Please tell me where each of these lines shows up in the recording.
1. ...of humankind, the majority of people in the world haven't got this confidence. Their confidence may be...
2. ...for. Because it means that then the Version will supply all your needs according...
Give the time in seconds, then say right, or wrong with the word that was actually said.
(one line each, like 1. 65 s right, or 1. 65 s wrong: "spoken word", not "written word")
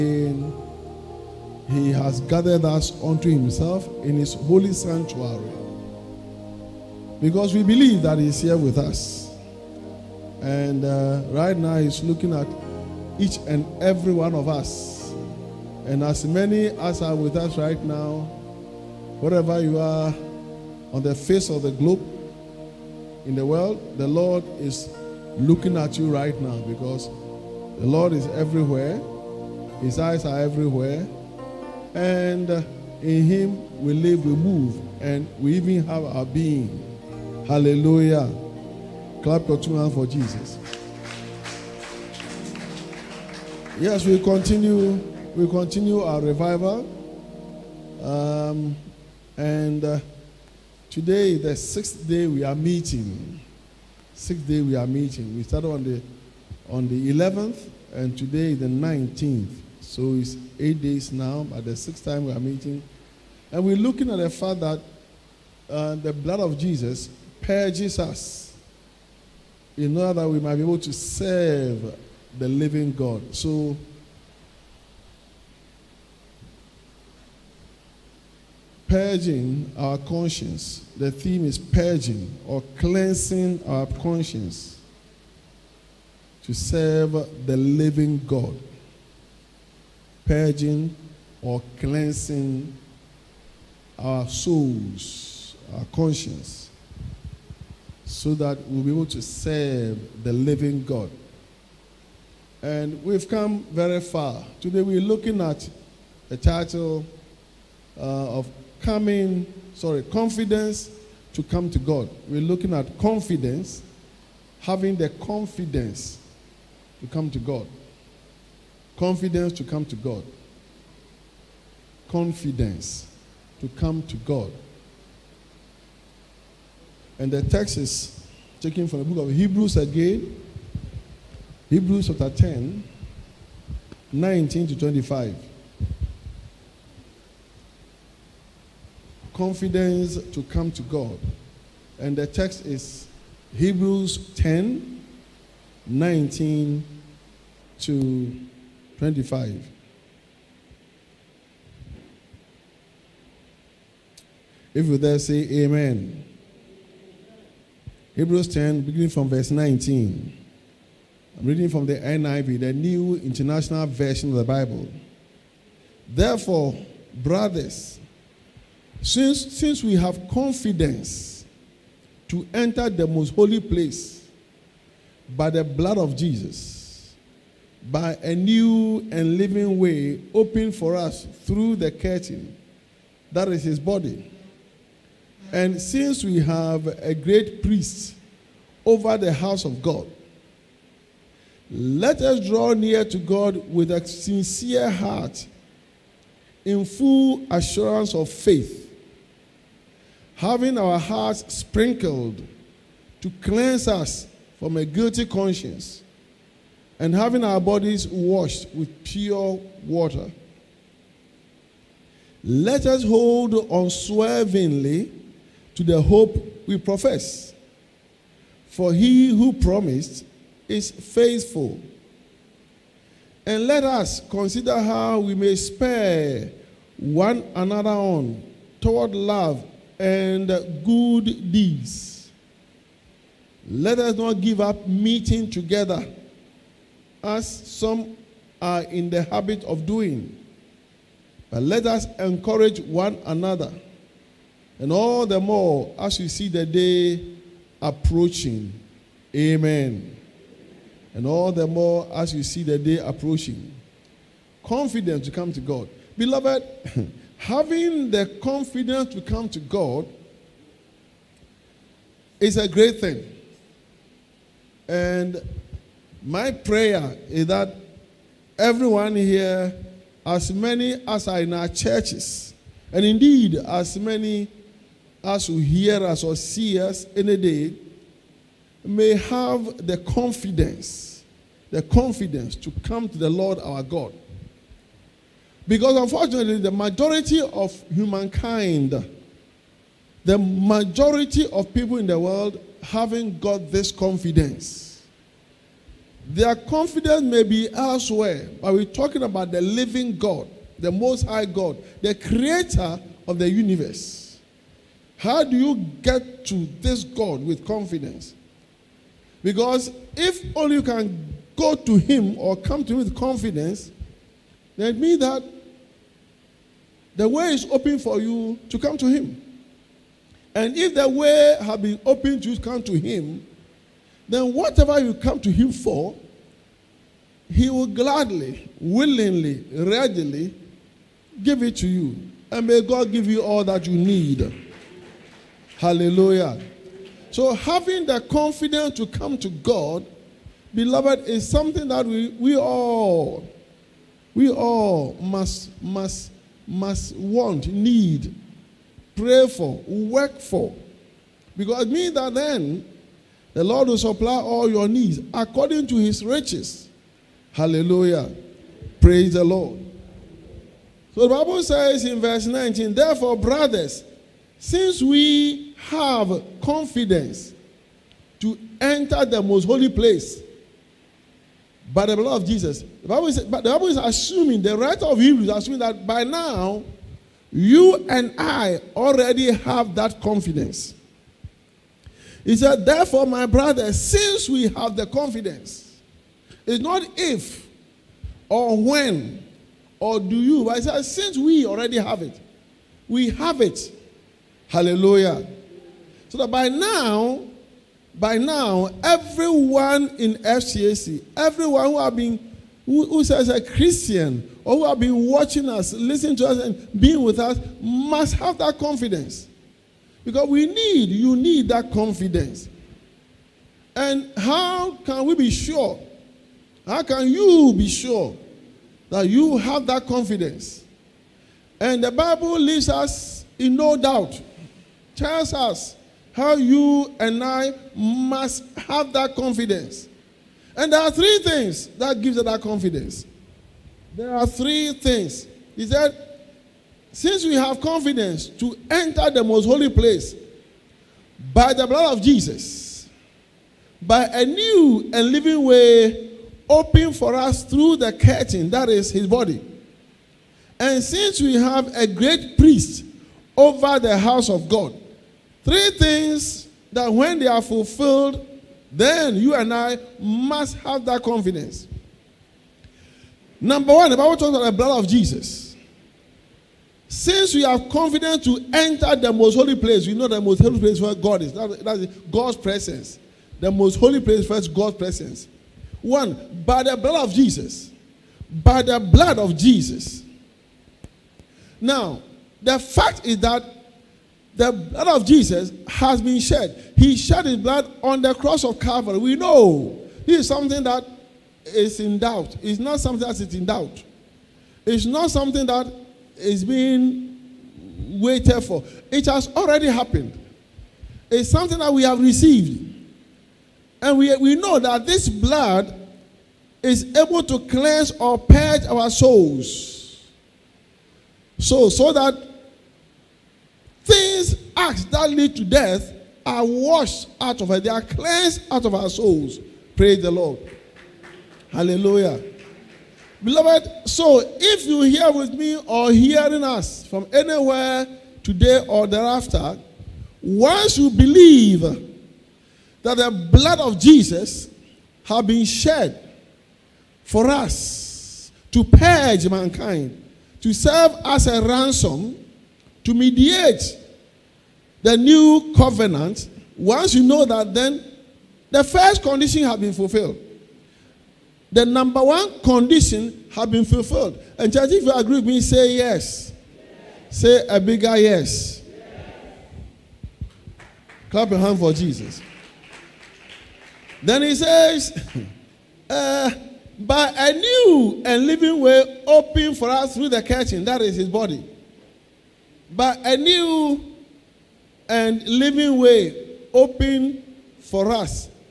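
1. 287 s right
2. 350 s wrong: "Lord", not "Version".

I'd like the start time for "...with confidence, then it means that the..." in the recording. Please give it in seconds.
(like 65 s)
312 s.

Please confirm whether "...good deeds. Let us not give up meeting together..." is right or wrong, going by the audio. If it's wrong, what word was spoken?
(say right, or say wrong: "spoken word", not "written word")
right.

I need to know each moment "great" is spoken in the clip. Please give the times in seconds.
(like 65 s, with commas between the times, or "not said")
187 s, 262 s, 452 s.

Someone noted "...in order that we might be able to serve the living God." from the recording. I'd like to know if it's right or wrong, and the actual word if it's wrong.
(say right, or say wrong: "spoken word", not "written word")
right.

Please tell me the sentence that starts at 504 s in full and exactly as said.
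And we, we know that this blood is able to cleanse or purge our souls.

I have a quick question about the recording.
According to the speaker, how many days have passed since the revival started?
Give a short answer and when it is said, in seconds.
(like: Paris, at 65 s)
8, at 60 s.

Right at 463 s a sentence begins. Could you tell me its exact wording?
Number one, the Bible talks about the blood of Jesus.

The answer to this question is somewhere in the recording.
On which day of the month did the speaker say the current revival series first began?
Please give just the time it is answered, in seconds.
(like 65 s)
57 s.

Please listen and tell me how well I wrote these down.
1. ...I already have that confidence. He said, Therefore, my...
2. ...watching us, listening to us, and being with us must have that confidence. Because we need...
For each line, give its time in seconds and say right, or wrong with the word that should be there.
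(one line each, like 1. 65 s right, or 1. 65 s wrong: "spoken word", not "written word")
1. 378 s right
2. 405 s right.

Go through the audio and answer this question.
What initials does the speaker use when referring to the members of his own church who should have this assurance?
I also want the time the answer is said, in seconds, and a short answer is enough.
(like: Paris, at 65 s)
FCAC, at 400 s.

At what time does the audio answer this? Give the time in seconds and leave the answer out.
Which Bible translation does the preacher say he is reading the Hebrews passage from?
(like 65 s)
162 s.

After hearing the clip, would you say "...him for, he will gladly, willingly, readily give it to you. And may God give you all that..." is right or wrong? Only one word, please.
right.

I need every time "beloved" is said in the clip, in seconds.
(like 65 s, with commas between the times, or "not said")
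256 s, 340 s, 523 s.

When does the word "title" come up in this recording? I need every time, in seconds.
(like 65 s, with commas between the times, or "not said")
106 s.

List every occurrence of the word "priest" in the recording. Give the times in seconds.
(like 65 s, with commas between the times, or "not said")
187 s, 452 s.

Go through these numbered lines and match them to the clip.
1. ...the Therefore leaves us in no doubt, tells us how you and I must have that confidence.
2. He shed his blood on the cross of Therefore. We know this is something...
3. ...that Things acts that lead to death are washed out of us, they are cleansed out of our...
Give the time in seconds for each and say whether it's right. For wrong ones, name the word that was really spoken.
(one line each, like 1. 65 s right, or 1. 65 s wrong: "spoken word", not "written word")
1. 422 s wrong: "Bible", not "Therefore"
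2. 486 s wrong: "Calvary", not "Therefore"
3. 512 s right.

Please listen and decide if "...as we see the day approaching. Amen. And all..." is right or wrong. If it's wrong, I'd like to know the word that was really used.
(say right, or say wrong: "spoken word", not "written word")
right.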